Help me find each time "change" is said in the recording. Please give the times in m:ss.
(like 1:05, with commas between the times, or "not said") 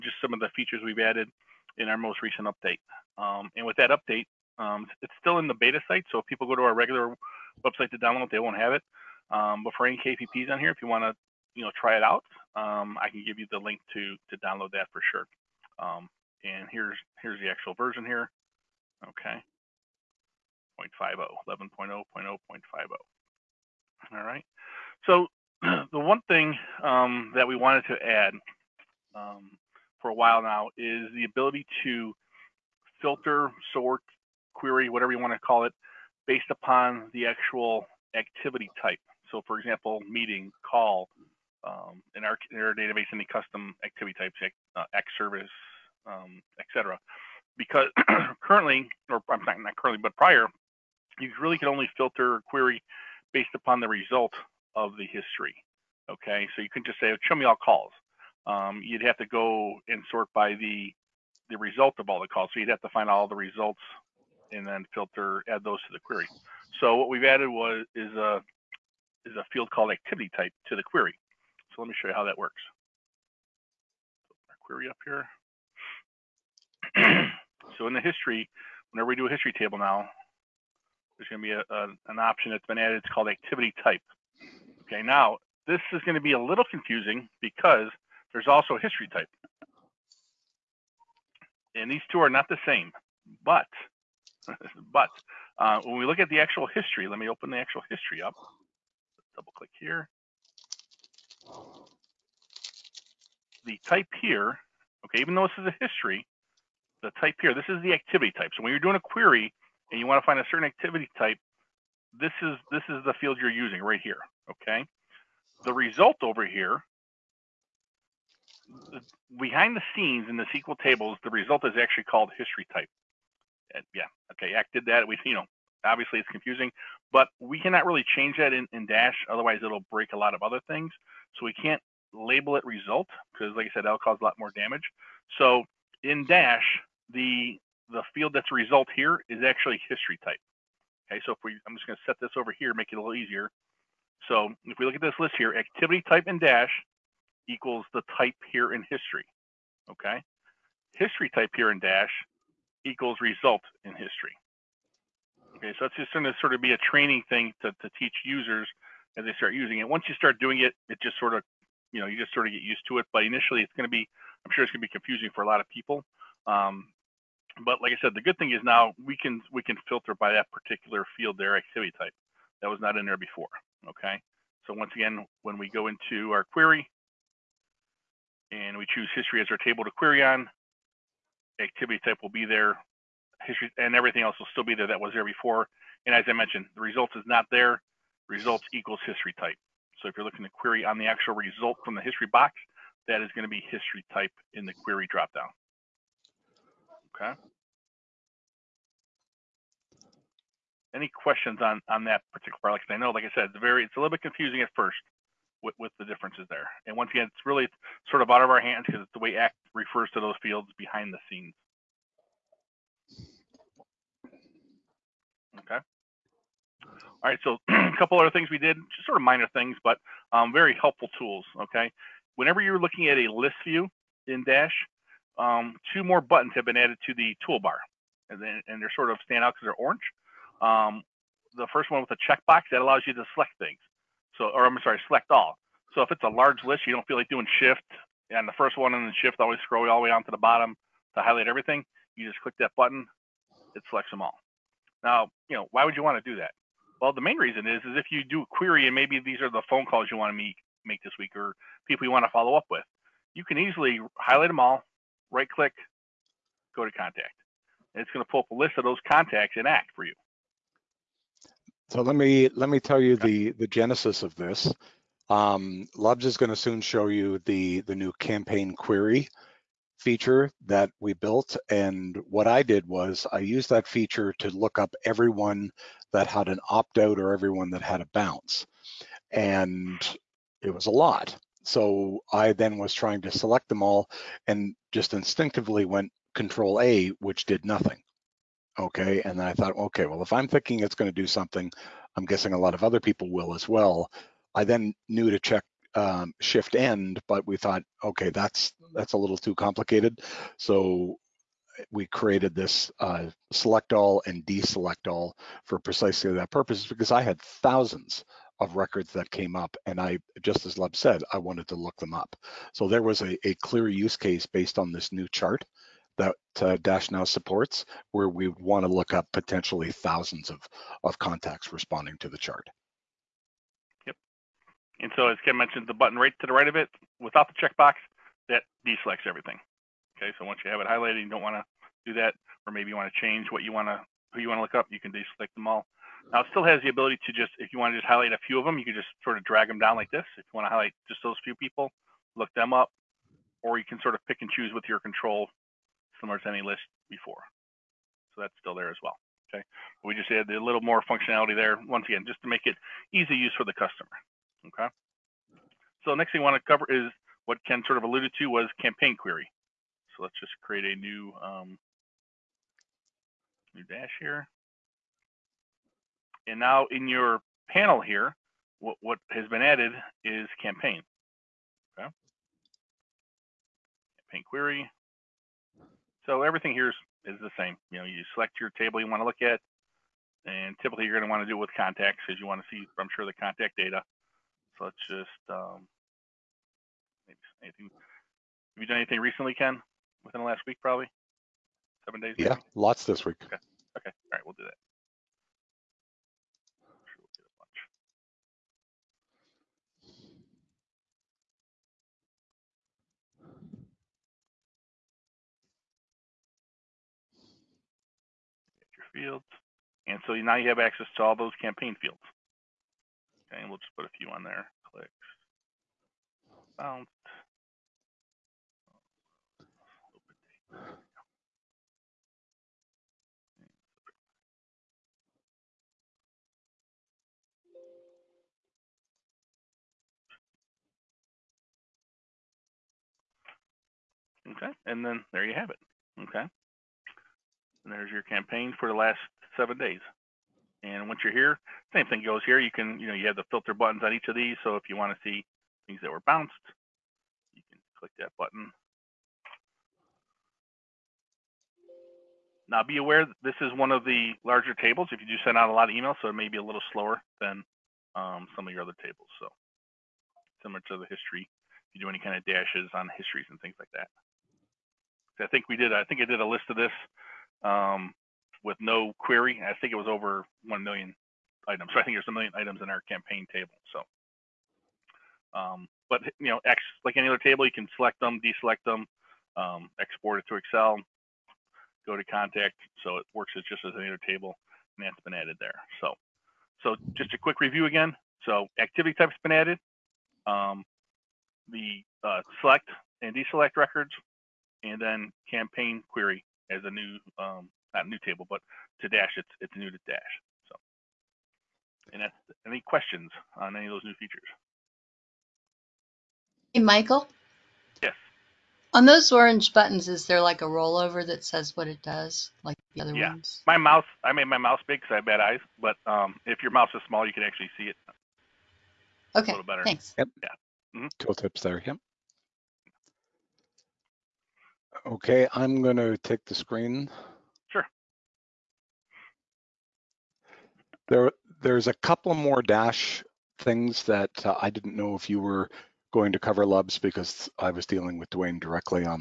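2:08, 5:33.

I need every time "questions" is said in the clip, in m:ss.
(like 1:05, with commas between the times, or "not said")
3:21, 8:22.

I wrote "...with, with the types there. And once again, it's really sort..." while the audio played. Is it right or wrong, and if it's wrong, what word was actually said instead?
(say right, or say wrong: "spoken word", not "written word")
wrong: "differences", not "types".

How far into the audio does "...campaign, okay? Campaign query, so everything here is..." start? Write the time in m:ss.
6:10.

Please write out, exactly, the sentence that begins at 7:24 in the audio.
So if you want to see things that were bounced, you can click that button.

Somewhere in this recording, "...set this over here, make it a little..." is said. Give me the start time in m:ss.
2:22.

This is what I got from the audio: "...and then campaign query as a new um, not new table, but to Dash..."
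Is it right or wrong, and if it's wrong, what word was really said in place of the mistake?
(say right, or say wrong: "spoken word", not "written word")
right.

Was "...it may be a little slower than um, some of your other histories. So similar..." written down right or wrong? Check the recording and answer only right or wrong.
wrong.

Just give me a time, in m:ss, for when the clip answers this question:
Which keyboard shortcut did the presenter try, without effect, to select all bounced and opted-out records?
4:46.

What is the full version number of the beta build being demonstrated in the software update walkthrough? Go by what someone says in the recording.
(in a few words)
11.0.0.50.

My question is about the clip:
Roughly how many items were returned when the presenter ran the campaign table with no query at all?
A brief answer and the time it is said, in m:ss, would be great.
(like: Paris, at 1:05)
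over 1 million, at 7:50.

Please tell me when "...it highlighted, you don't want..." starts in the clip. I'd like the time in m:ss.
5:30.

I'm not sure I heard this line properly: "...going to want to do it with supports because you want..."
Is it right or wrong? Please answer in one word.
wrong.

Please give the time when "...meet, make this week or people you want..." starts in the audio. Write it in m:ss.
4:10.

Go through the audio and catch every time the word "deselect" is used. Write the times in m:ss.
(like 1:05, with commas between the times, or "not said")
5:04, 5:28, 5:35, 7:58, 8:13.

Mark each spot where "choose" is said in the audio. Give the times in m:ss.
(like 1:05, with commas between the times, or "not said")
2:58, 5:44.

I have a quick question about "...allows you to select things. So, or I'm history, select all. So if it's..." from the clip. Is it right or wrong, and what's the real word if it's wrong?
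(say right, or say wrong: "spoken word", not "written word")
wrong: "sorry", not "history".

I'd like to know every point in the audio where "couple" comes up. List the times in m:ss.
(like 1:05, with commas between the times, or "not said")
3:37, 8:51.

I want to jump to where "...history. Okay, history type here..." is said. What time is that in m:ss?
2:28.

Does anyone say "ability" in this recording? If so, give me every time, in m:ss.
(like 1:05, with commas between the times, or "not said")
0:31, 5:36.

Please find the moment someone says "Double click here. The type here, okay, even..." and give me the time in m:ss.
1:39.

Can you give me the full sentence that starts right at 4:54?
I then knew to check um, shift end, but we thought, okay, that's that's a little too complicated.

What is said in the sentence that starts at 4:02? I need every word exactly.
You just click that button, it selects them all.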